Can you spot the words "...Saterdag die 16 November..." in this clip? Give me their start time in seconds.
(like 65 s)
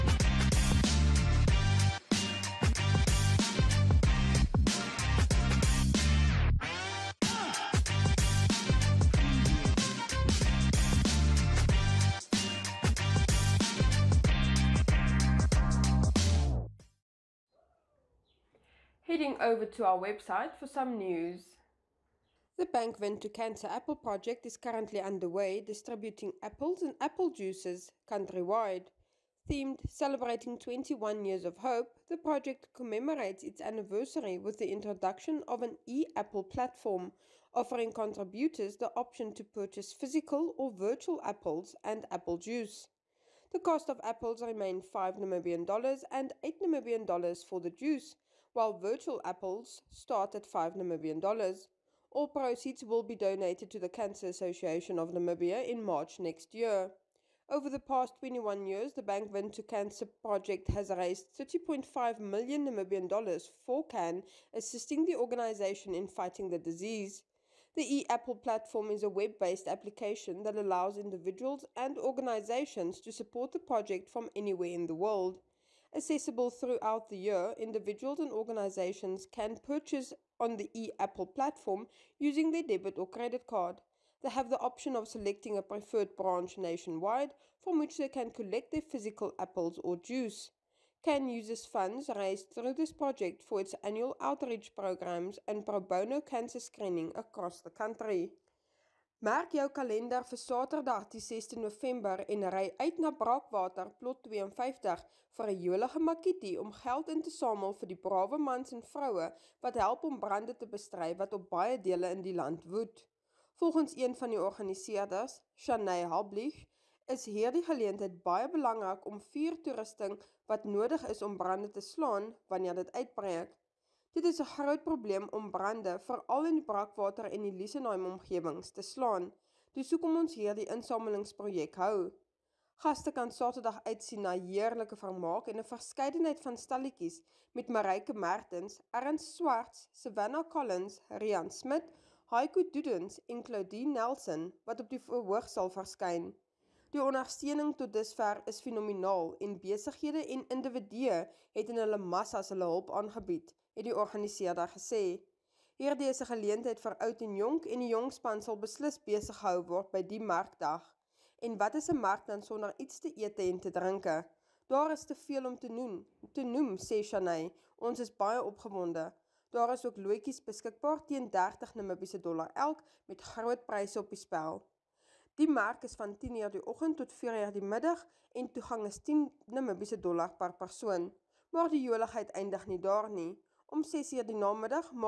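100 s.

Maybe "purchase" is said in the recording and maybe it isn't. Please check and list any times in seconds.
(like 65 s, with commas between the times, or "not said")
39 s, 79 s.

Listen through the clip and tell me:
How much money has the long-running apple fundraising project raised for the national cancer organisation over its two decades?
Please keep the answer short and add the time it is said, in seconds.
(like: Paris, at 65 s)
30.5 million Namibian dollars, at 61 s.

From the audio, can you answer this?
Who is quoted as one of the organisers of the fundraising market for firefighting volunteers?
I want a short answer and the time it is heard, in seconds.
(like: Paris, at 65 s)
Shanay Hablich, at 115 s.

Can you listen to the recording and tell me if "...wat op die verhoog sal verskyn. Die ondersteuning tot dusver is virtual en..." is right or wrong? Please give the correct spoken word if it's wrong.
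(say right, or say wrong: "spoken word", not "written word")
wrong: "fenomenaal", not "virtual".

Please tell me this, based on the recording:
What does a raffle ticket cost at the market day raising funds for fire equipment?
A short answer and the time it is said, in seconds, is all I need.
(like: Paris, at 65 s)
30 Namibian dollars, at 171 s.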